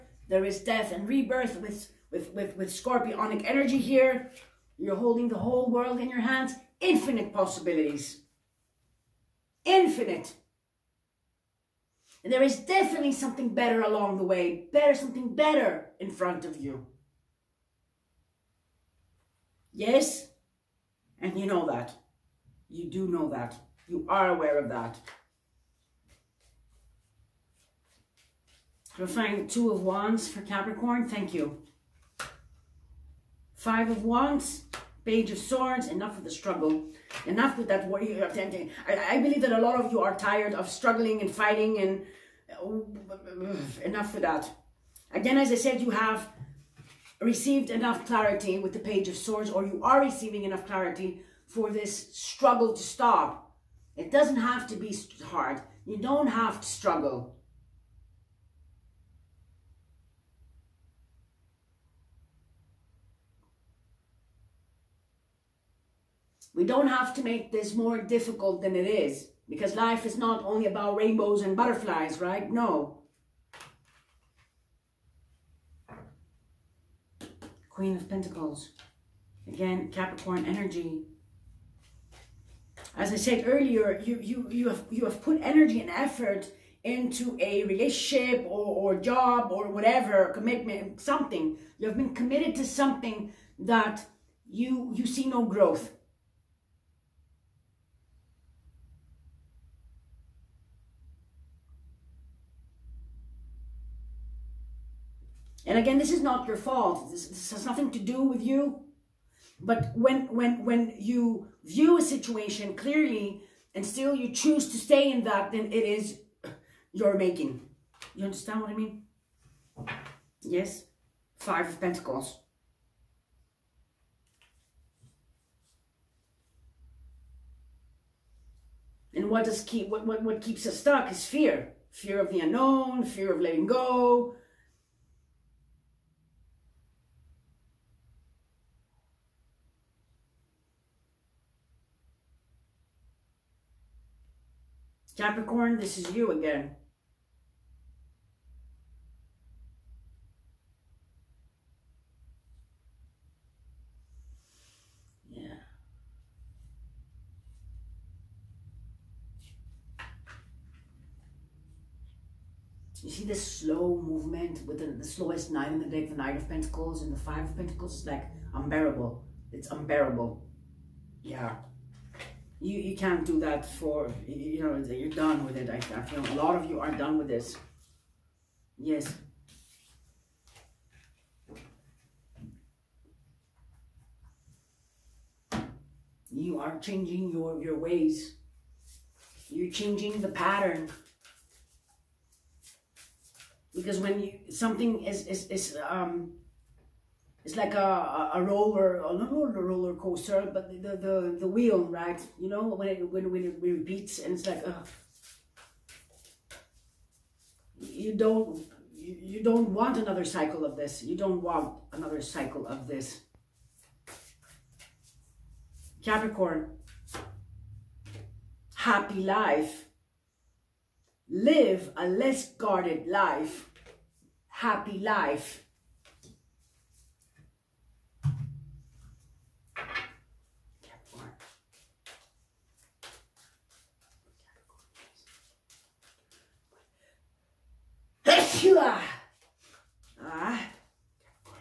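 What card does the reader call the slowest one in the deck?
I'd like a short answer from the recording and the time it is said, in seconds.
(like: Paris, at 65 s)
Knight of Pentacles, at 166 s.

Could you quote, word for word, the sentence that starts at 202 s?
You know, when it, when, when it repeats and it's like, ugh.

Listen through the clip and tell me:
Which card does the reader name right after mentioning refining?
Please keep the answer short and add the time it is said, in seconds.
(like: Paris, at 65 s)
Two of Wands, at 29 s.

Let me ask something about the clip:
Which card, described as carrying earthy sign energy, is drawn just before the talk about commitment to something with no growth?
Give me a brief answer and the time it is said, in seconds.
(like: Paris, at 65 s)
Queen of Pentacles, at 77 s.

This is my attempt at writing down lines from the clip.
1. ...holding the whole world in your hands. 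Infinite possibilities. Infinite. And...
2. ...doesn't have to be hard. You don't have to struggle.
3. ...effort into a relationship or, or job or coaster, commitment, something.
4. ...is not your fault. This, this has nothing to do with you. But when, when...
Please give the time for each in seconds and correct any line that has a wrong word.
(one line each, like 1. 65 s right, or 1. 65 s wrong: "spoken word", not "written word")
1. 4 s right
2. 54 s right
3. 85 s wrong: "whatever", not "coaster"
4. 106 s right.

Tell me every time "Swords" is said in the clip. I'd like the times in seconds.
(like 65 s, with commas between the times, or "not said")
35 s, 49 s.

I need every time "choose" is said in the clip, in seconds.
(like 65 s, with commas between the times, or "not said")
114 s.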